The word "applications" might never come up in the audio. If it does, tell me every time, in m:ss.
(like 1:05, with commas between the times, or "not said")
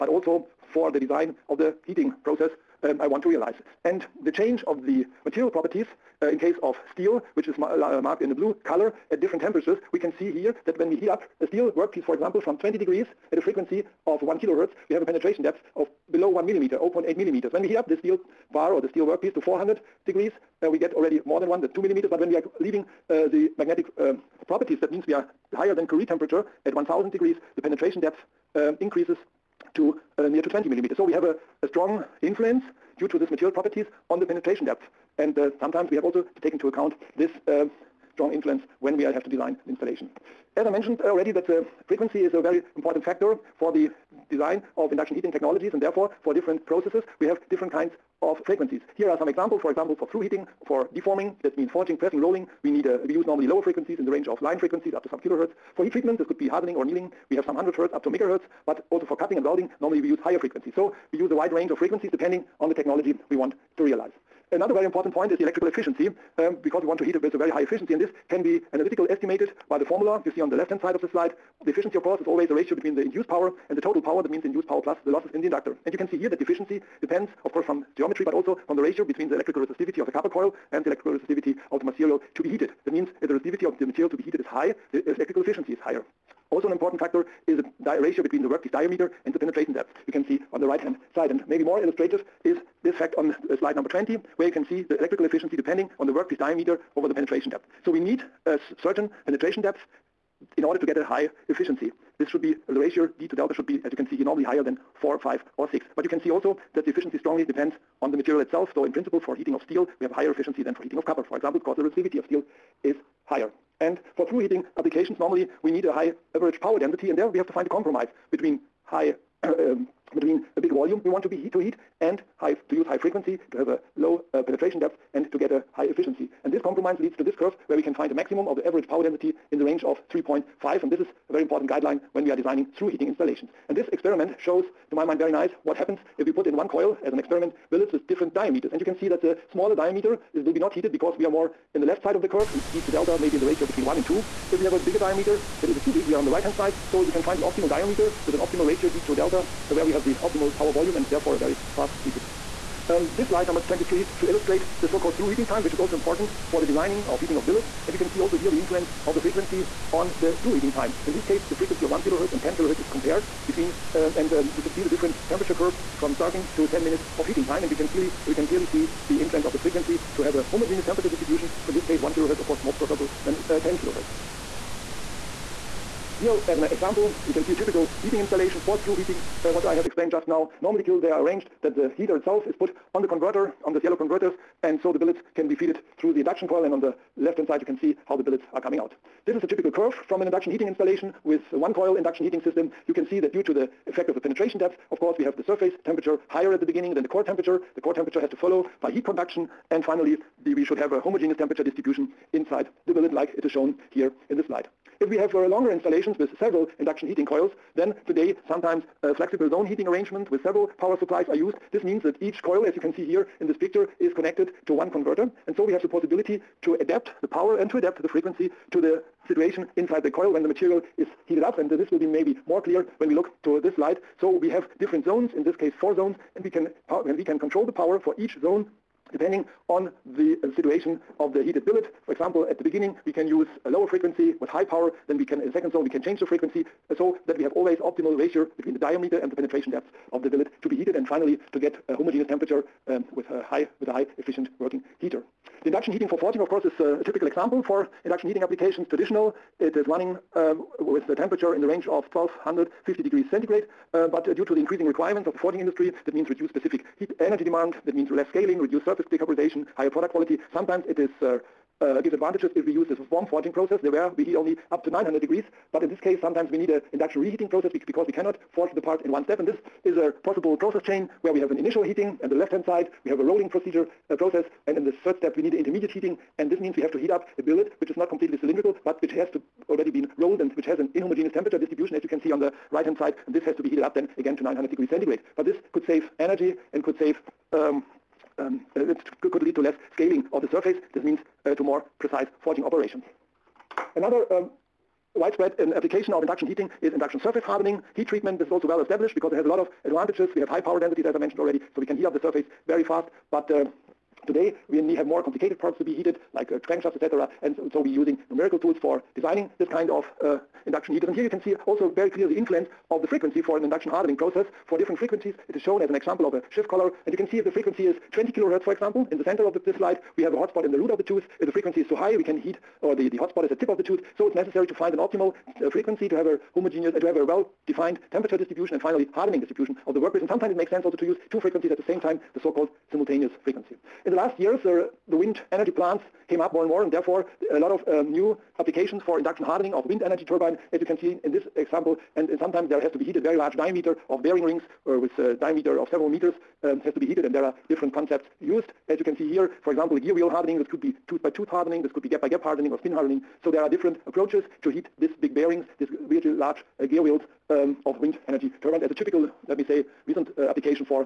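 1:54, 4:08, 4:55, 5:38, 6:00.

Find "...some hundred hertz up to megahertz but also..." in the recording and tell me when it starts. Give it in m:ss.
0:57.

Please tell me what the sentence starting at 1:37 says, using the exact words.
So we need a certain penetration depth in order to get a high efficiency.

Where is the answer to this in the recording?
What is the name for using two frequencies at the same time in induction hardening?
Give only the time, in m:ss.
5:32.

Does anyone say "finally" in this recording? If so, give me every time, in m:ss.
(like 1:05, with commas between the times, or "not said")
3:19, 4:01, 5:28.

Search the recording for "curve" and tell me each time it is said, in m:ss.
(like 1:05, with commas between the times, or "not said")
2:07, 2:22, 2:45, 3:09.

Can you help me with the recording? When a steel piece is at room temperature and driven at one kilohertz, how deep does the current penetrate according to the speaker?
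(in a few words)
0.8 millimeters.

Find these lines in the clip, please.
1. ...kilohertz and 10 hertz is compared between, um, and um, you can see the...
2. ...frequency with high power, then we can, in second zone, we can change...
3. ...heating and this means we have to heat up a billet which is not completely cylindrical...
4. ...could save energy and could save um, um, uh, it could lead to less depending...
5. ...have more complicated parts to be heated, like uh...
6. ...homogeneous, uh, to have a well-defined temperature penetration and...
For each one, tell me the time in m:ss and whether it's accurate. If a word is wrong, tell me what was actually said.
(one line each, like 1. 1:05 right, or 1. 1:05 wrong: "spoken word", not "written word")
1. 2:42 wrong: "kilohertz", not "hertz"
2. 3:53 right
3. 4:35 right
4. 4:45 wrong: "scaling", not "depending"
5. 5:04 right
6. 5:26 wrong: "distribution", not "penetration".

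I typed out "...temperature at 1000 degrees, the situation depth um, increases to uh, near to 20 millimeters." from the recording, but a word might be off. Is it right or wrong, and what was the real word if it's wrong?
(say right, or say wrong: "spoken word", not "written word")
wrong: "penetration", not "situation".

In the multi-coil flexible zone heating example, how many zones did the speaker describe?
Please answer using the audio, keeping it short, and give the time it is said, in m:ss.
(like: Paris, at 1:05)
4, at 3:45.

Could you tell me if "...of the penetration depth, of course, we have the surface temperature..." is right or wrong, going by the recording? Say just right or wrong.
right.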